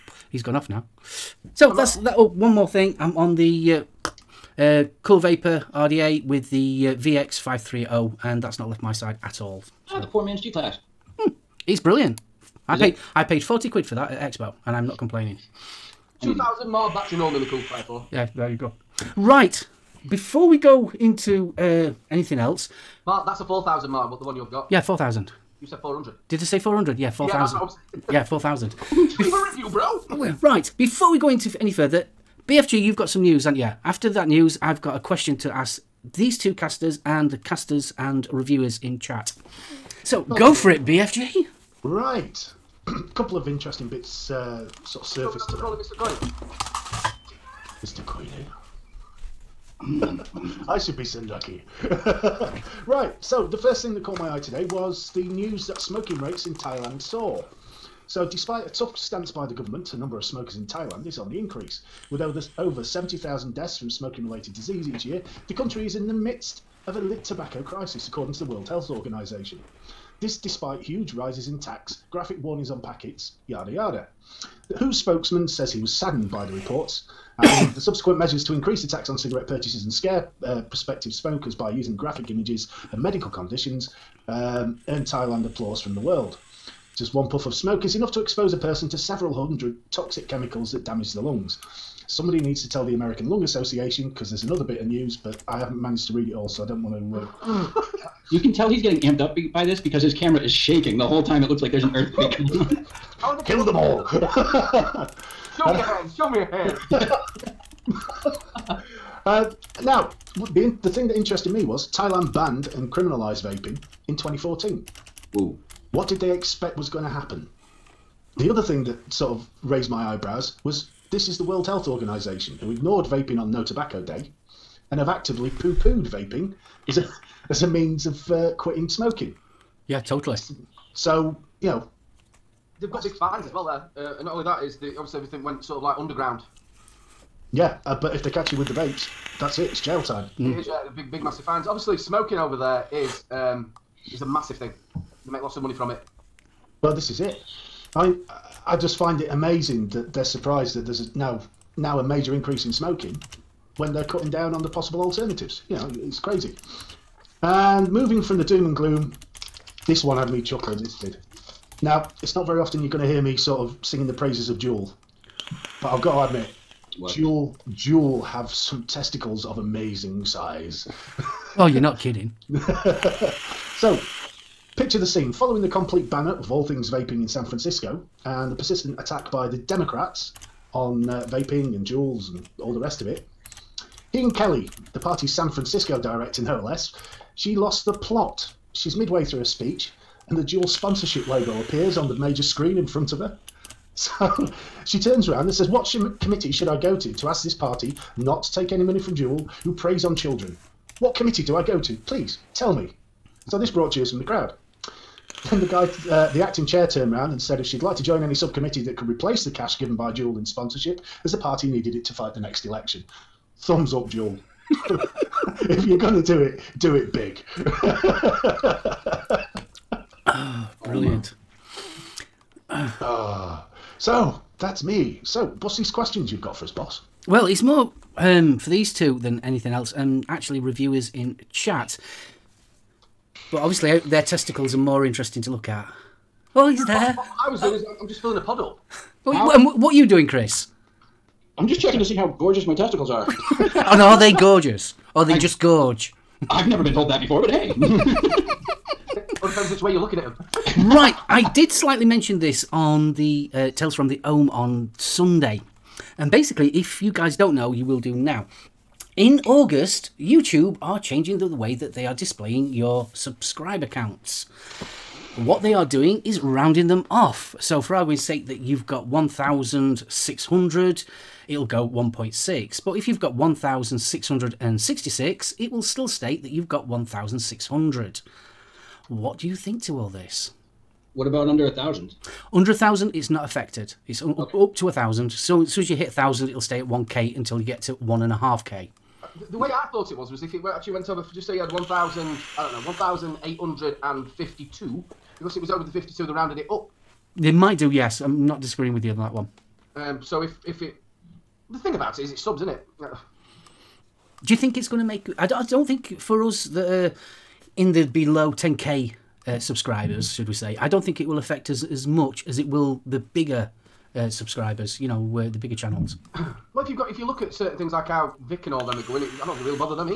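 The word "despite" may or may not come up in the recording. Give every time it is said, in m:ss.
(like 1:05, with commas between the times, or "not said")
0:58, 1:10.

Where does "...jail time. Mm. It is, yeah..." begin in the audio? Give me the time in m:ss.
2:19.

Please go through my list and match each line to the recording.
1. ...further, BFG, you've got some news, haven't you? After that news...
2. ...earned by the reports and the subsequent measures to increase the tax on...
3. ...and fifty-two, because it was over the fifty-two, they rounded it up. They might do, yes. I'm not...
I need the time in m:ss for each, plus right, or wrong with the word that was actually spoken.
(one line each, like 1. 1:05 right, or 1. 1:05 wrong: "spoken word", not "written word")
1. 0:31 right
2. 1:15 wrong: "saddened", not "earned"
3. 4:54 right.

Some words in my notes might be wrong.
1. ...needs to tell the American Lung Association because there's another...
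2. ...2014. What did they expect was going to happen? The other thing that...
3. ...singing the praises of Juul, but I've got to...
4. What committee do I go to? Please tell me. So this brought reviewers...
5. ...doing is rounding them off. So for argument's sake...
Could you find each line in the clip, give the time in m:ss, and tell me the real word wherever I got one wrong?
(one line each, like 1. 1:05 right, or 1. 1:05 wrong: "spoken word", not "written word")
1. 1:32 right
2. 1:54 right
3. 2:43 right
4. 3:20 wrong: "cheers", not "reviewers"
5. 4:25 right.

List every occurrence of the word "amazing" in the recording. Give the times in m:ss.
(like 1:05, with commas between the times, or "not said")
2:29, 2:49.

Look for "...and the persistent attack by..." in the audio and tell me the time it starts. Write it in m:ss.
2:58.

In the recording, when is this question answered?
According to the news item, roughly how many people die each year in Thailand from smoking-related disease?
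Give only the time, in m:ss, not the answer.
1:02.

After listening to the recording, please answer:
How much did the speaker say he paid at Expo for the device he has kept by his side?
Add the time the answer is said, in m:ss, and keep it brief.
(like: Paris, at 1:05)
£40, at 0:13.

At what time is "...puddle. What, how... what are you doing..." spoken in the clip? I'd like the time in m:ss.
3:58.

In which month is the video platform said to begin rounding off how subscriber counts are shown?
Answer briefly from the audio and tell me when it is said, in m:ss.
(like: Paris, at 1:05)
August, at 4:19.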